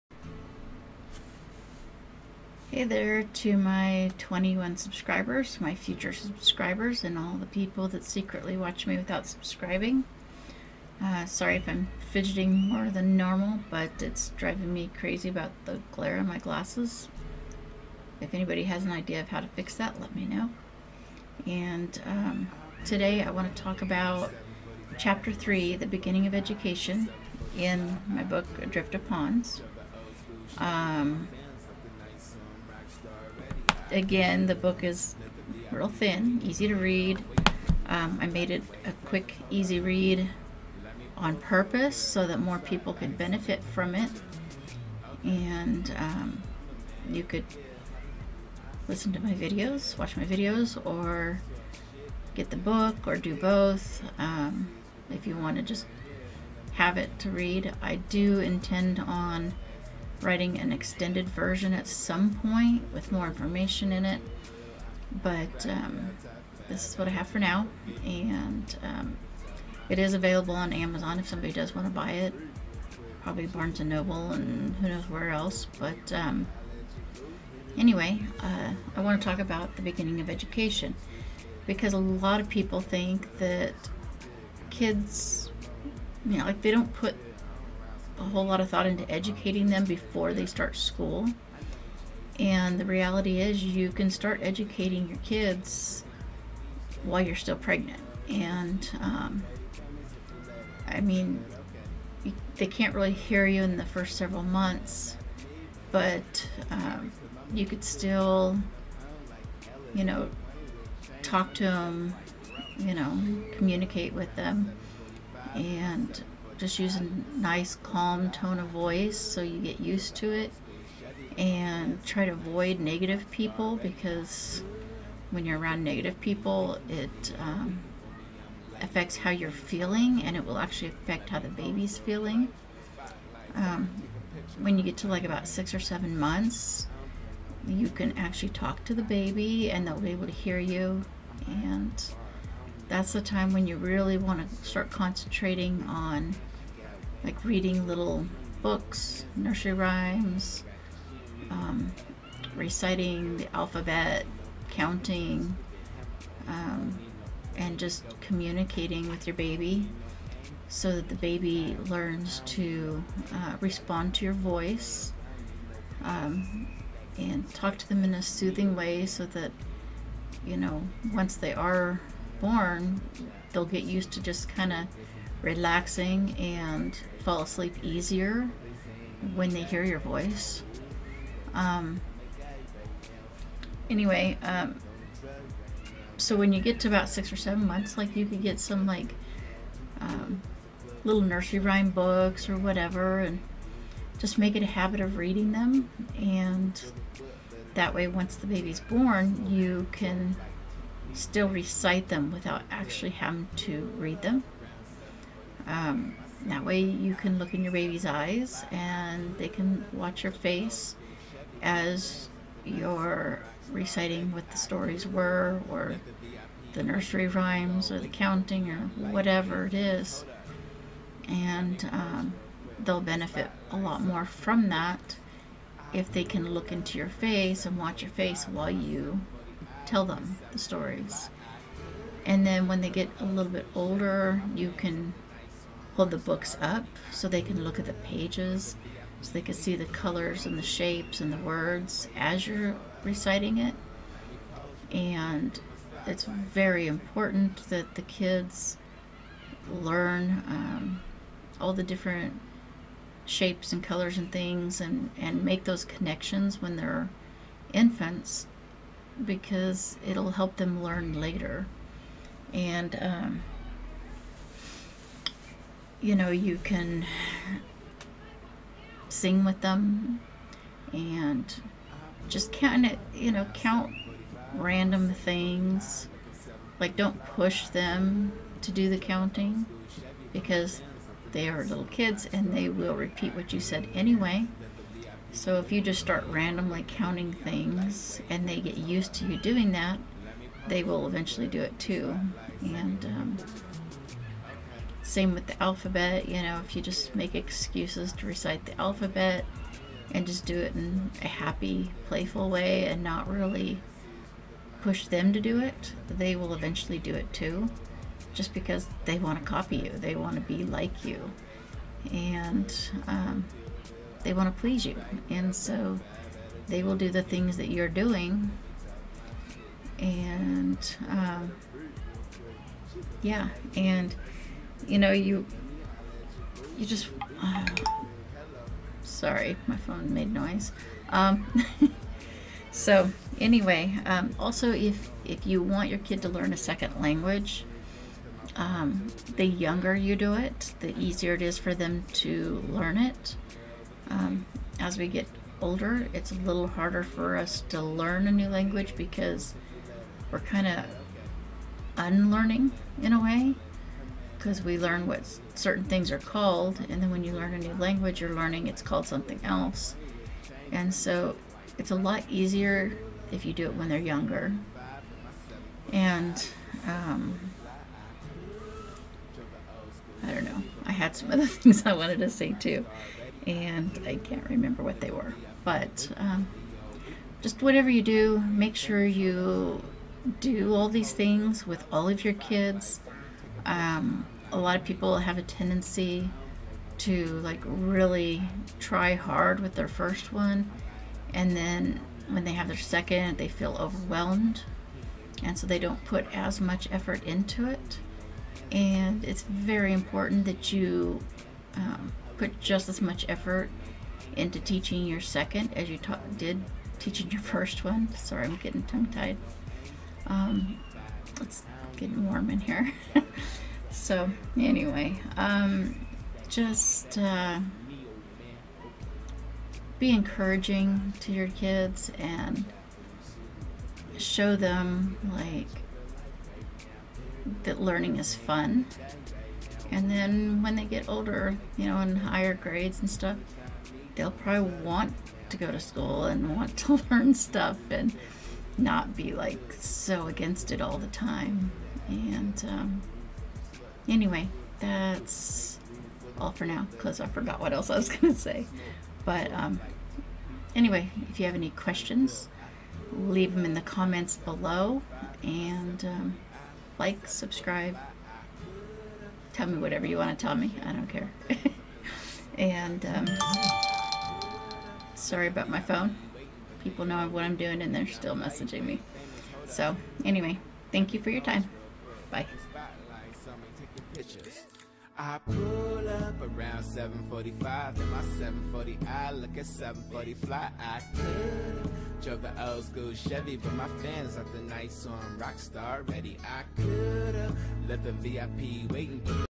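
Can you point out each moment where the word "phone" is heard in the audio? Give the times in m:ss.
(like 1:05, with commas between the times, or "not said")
5:29, 7:45.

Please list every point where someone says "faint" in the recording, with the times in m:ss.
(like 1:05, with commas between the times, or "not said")
not said.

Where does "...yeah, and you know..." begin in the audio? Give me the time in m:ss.
5:23.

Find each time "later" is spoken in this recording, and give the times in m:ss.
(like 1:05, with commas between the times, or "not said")
4:21.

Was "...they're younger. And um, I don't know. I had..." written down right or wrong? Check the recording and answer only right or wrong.
right.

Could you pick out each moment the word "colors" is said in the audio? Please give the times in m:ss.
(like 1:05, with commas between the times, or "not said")
3:59, 4:13.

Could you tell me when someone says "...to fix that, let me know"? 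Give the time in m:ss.
0:19.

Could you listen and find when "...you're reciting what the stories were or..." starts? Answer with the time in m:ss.
3:32.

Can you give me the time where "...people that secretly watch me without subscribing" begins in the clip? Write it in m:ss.
0:07.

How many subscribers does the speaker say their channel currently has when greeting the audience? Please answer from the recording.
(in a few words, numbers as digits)
21.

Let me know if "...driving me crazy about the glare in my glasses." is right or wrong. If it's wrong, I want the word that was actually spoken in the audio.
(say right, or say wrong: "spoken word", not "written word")
right.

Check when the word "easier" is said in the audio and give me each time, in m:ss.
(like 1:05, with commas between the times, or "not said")
2:57, 5:40, 6:02.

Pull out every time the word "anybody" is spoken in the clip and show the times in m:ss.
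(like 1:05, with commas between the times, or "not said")
0:18.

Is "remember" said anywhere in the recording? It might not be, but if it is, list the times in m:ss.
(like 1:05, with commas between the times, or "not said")
6:14.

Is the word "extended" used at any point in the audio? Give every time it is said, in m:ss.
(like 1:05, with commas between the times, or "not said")
1:00.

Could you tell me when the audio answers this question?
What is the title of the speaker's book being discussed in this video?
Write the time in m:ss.
0:28.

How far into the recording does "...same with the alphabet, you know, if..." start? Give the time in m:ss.
4:55.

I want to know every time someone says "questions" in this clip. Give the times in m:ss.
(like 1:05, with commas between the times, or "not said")
7:31.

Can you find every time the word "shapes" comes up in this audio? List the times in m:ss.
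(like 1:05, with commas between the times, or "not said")
4:00, 4:13.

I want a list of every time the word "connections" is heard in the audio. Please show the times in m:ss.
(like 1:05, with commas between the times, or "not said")
4:15.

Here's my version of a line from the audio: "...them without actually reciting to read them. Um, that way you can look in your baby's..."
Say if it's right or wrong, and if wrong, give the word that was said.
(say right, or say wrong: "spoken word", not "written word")
wrong: "having", not "reciting".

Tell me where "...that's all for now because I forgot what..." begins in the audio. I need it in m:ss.
7:24.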